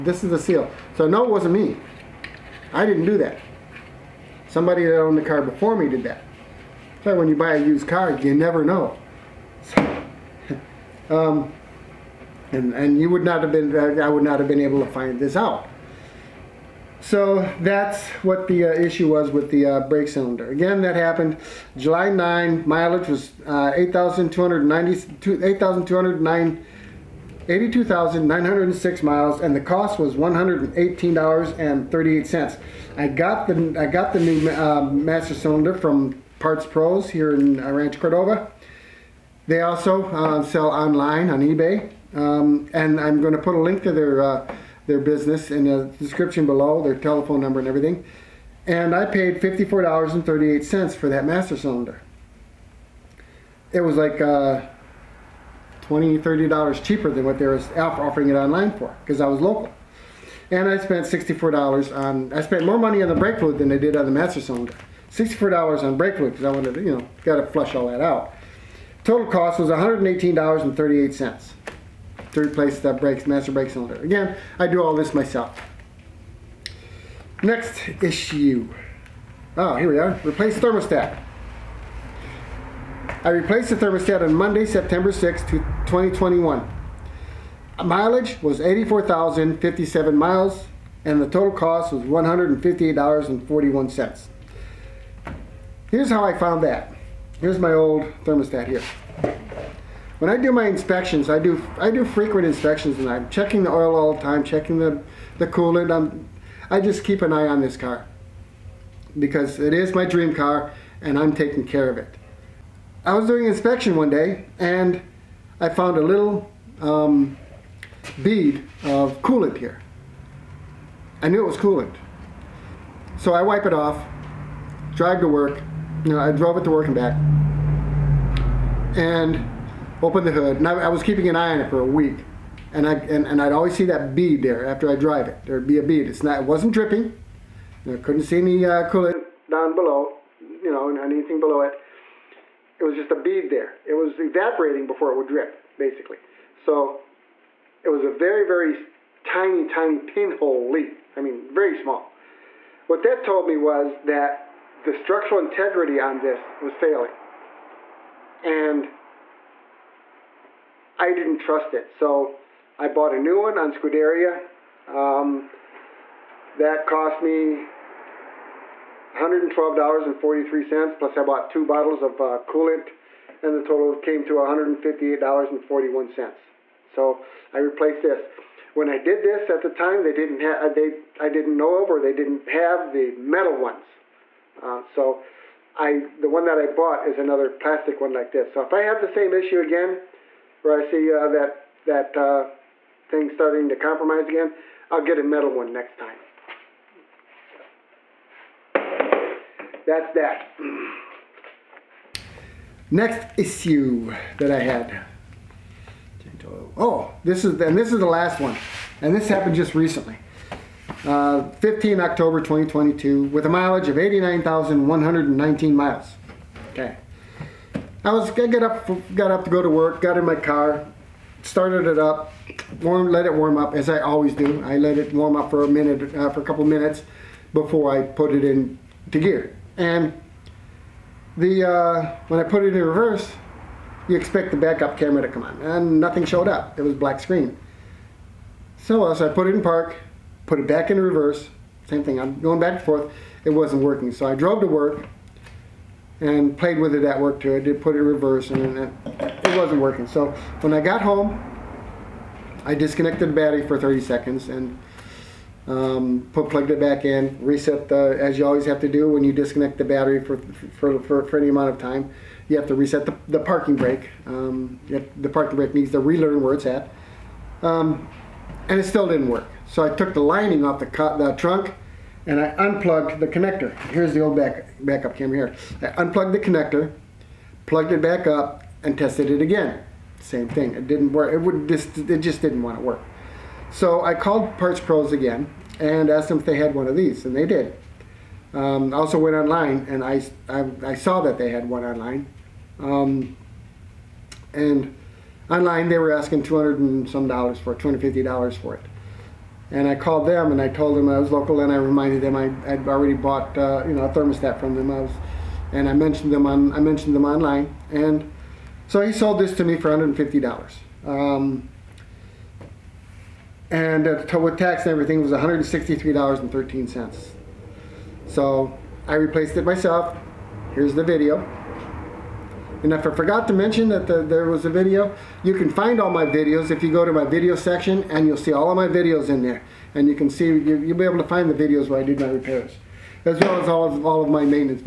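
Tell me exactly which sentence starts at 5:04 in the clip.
I was, and I mentioned them on I mentioned them online and so he sold this to me for $150.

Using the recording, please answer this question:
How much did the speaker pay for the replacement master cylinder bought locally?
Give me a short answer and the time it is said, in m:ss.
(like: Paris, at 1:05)
$54.38, at 0:49.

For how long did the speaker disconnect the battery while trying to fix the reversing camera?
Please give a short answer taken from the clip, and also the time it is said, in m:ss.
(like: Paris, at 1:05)
30 seconds, at 4:13.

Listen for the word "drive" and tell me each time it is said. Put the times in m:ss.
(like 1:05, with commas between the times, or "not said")
2:04, 2:14.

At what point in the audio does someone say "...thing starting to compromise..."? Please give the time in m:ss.
3:13.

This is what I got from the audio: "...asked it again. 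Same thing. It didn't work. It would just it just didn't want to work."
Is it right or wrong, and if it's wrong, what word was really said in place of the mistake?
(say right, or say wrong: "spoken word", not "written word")
wrong: "tested", not "asked".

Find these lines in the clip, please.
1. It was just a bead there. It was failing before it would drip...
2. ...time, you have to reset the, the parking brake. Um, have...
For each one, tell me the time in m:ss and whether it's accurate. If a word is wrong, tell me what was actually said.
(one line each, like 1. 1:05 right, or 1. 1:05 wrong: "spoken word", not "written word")
1. 2:22 wrong: "evaporating", not "failing"
2. 4:21 right.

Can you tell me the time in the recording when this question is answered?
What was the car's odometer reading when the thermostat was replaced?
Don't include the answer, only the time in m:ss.
1:28.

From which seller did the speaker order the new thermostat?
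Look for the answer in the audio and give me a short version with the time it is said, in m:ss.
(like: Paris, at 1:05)
Scuderia, at 2:43.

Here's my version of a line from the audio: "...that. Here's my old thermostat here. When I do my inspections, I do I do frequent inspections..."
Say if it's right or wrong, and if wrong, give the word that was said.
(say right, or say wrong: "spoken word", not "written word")
right.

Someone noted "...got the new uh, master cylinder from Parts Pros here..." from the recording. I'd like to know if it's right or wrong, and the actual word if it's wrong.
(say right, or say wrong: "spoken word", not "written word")
right.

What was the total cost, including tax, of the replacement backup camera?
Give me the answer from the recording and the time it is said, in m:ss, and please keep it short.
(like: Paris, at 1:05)
$163.13, at 5:15.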